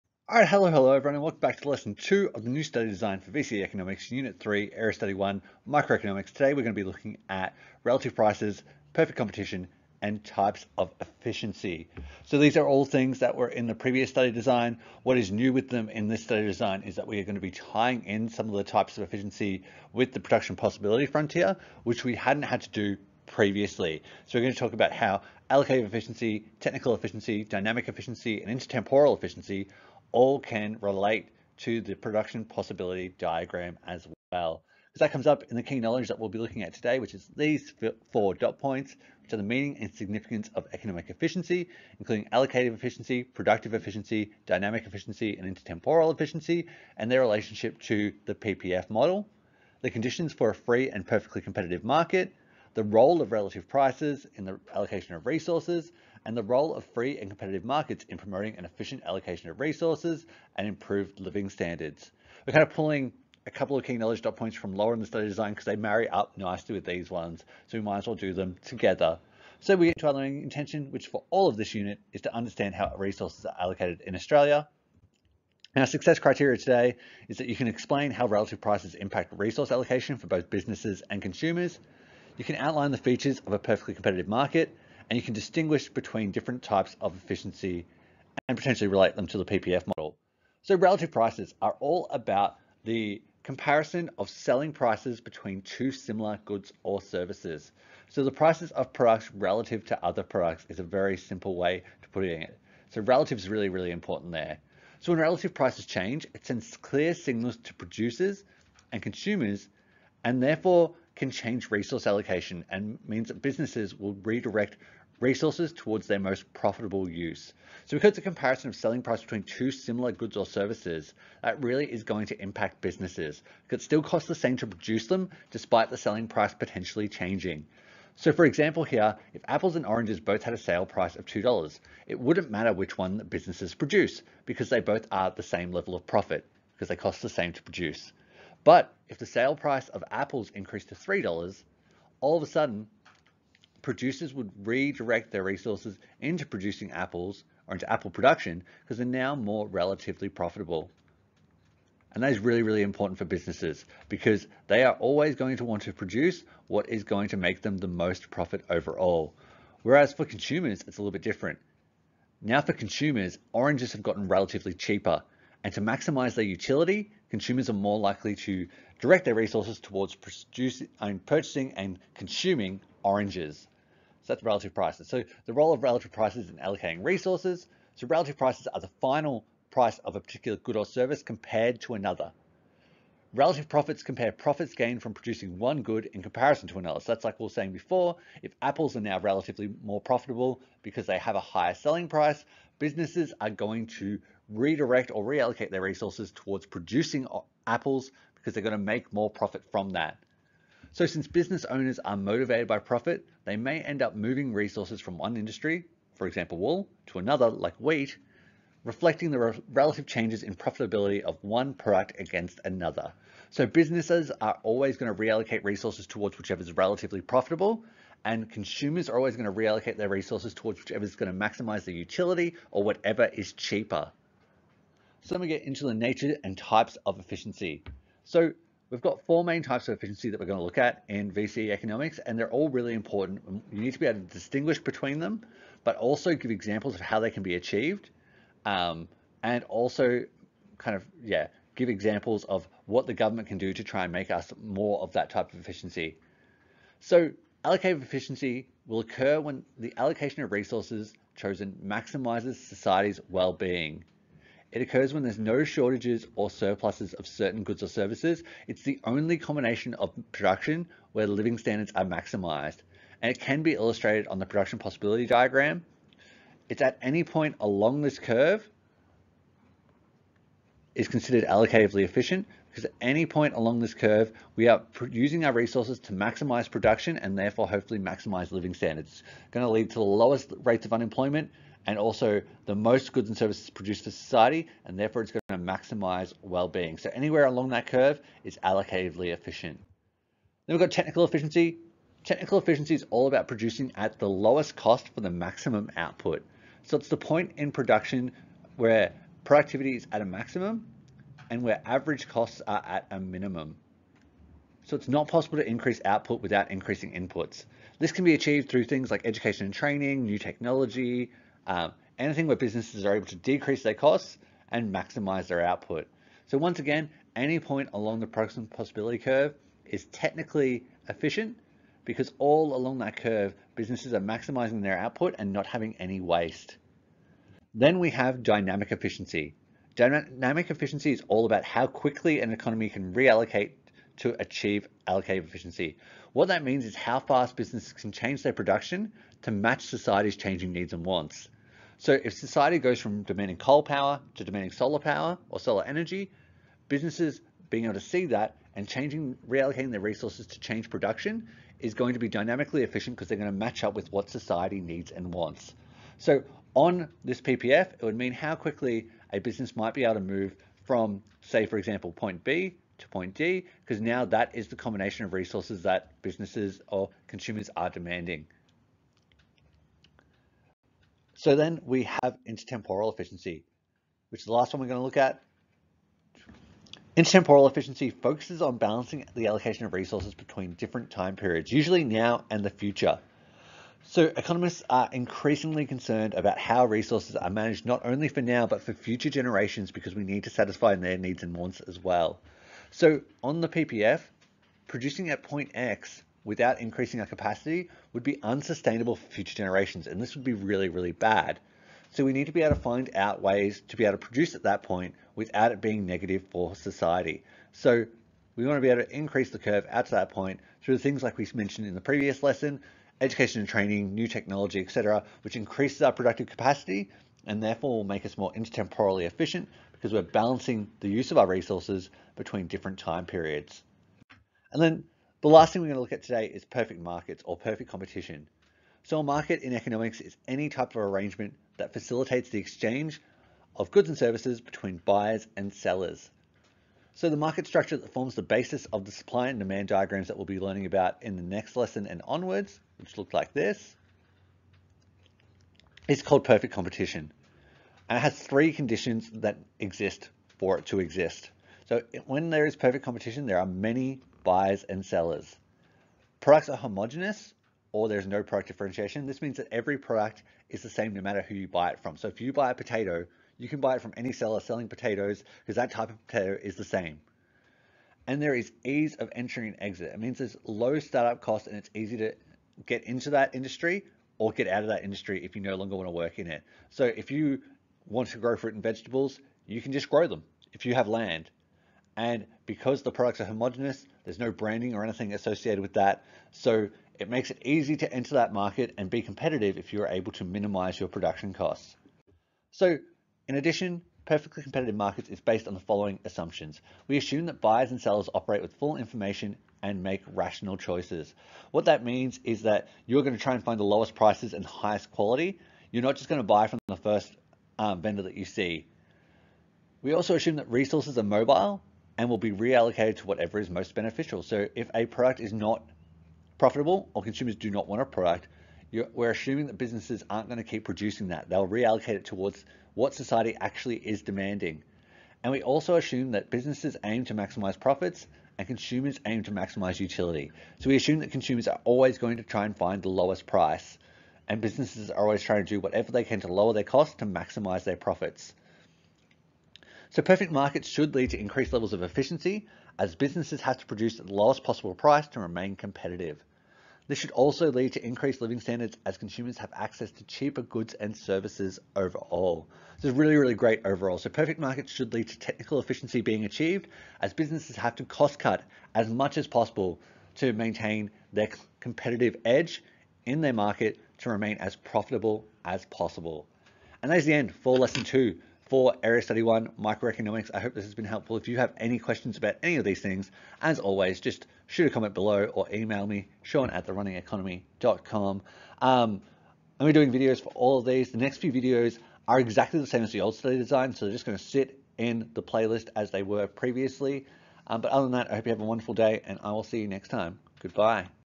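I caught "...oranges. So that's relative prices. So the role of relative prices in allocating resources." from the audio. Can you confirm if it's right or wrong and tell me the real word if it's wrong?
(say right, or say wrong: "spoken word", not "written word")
right.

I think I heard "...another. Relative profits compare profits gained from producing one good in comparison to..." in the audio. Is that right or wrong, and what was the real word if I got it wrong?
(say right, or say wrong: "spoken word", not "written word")
right.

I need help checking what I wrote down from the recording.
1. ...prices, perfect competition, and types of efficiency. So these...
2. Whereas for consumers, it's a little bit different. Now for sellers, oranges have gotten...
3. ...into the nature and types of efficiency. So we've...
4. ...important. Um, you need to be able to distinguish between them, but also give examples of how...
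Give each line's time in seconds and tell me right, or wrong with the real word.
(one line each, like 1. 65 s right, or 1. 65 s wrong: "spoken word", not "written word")
1. 8 s right
2. 159 s wrong: "consumers", not "sellers"
3. 225 s right
4. 232 s right.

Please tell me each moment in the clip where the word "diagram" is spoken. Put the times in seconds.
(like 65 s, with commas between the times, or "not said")
33 s, 265 s, 439 s.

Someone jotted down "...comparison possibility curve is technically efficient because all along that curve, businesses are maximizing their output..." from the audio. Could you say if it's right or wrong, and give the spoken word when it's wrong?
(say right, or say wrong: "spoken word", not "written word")
wrong: "production", not "comparison".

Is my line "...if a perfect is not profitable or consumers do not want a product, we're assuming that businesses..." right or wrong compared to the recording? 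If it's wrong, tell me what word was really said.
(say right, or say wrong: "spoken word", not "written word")
wrong: "product", not "perfect".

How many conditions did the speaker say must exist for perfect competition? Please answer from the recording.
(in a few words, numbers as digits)
3.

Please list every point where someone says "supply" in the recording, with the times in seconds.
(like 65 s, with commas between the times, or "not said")
439 s.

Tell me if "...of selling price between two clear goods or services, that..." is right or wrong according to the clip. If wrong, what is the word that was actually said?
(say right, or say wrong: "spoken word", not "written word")
wrong: "similar", not "clear".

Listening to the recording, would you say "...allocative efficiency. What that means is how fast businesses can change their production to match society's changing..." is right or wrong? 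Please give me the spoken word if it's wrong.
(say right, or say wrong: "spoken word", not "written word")
right.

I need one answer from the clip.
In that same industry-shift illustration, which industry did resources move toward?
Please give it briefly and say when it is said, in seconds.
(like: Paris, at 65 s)
wheat, at 207 s.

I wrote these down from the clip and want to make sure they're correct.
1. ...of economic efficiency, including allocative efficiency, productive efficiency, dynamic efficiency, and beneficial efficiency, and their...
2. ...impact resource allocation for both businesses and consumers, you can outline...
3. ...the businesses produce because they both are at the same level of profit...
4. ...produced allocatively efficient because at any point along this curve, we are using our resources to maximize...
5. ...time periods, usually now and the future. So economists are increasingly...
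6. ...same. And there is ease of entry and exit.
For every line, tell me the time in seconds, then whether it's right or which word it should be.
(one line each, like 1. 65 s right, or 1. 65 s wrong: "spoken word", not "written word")
1. 40 s wrong: "intertemporal", not "beneficial"
2. 78 s right
3. 133 s right
4. 271 s wrong: "considered", not "produced"
5. 381 s right
6. 466 s right.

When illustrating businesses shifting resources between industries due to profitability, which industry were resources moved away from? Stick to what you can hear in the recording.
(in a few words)
wool.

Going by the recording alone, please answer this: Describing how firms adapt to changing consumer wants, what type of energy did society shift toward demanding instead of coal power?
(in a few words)
solar energy.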